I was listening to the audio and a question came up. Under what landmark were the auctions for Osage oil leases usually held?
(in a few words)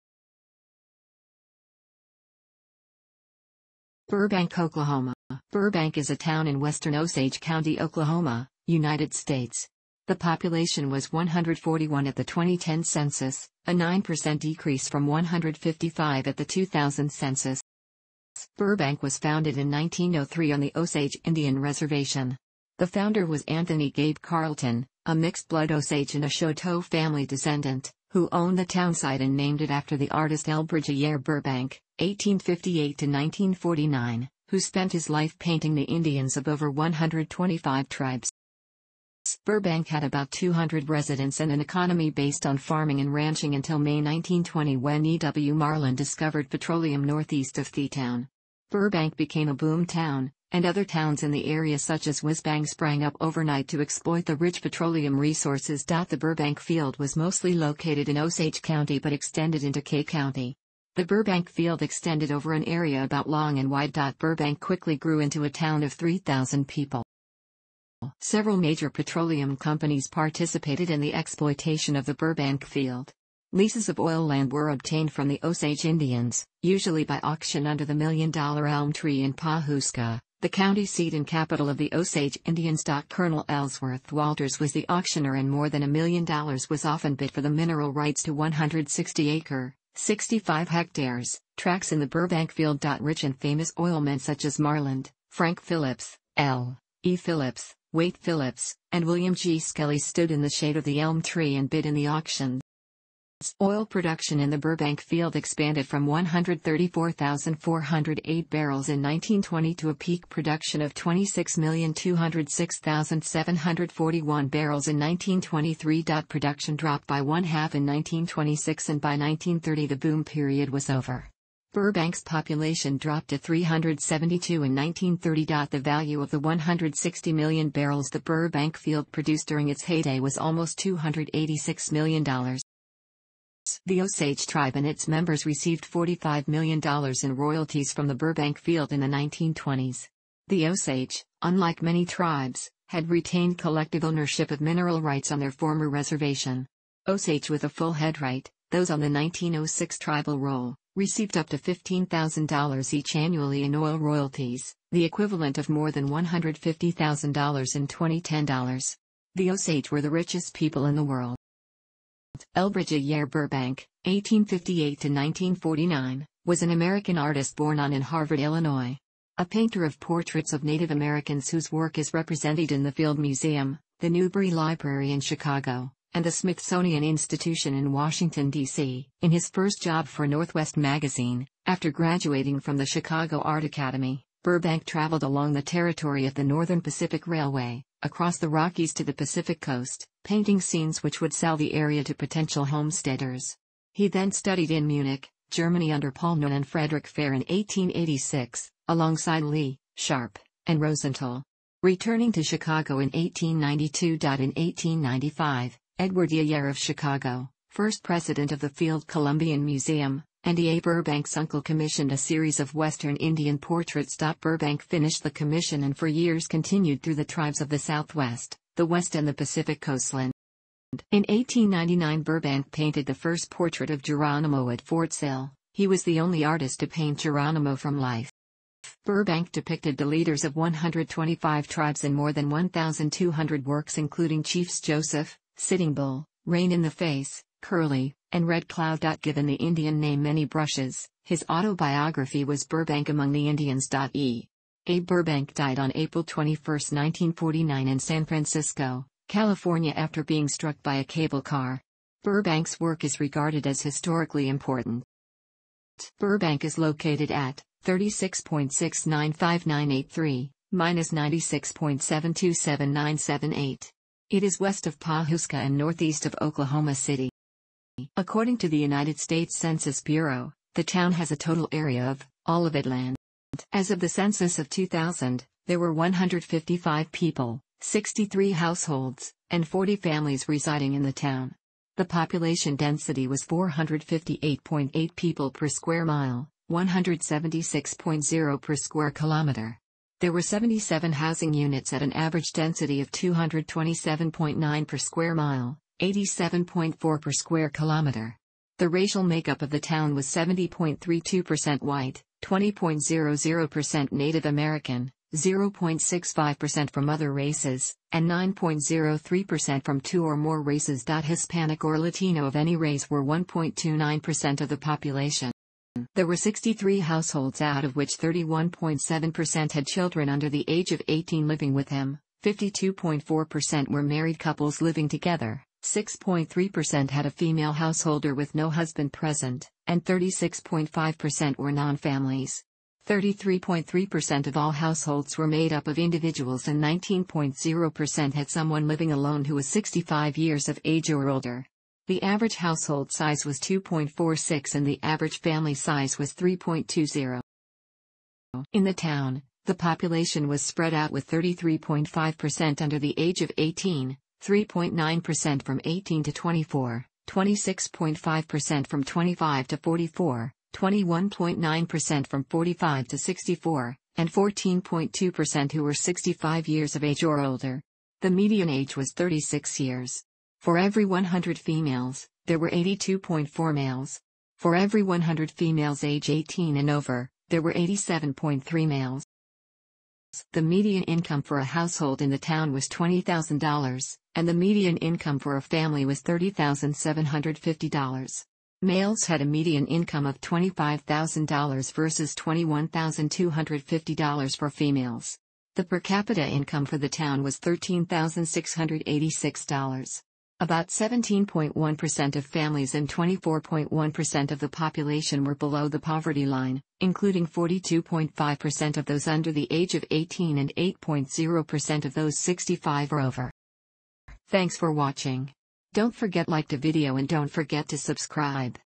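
Million Dollar Elm Tree.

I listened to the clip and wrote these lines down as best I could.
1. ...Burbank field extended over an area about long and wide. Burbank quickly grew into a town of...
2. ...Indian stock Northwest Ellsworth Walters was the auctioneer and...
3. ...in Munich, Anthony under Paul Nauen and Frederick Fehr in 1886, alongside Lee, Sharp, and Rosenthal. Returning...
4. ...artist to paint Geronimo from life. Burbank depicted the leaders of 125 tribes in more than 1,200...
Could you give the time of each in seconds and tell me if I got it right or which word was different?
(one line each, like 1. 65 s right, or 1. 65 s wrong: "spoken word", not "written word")
1. 61 s right
2. 82 s wrong: "Colonel", not "Northwest"
3. 194 s wrong: "Germany", not "Anthony"
4. 226 s right.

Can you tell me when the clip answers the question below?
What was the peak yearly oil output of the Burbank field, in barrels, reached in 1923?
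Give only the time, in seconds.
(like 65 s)
110 s.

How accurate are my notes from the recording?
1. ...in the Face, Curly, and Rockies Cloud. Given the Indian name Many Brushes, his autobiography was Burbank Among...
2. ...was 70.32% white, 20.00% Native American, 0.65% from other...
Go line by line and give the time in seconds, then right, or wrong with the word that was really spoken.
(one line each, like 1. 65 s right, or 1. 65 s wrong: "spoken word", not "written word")
1. 236 s wrong: "Red", not "Rockies"
2. 300 s right.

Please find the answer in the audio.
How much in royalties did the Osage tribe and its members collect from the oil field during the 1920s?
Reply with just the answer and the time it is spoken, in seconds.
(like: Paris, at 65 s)
$45 million, at 135 s.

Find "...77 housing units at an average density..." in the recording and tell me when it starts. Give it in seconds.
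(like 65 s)
290 s.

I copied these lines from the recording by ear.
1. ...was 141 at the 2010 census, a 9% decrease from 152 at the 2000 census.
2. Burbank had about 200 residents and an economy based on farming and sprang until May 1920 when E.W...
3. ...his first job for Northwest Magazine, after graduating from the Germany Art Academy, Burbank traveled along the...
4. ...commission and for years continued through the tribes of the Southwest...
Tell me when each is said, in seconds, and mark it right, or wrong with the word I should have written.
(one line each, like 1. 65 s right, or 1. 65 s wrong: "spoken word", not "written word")
1. 10 s wrong: "155", not "152"
2. 39 s wrong: "ranching", not "sprang"
3. 179 s wrong: "Chicago", not "Germany"
4. 215 s right.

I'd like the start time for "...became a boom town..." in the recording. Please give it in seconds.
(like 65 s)
49 s.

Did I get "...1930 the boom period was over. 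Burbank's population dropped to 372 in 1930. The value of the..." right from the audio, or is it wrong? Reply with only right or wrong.
right.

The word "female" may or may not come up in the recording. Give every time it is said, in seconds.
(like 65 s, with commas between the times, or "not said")
327 s, 394 s.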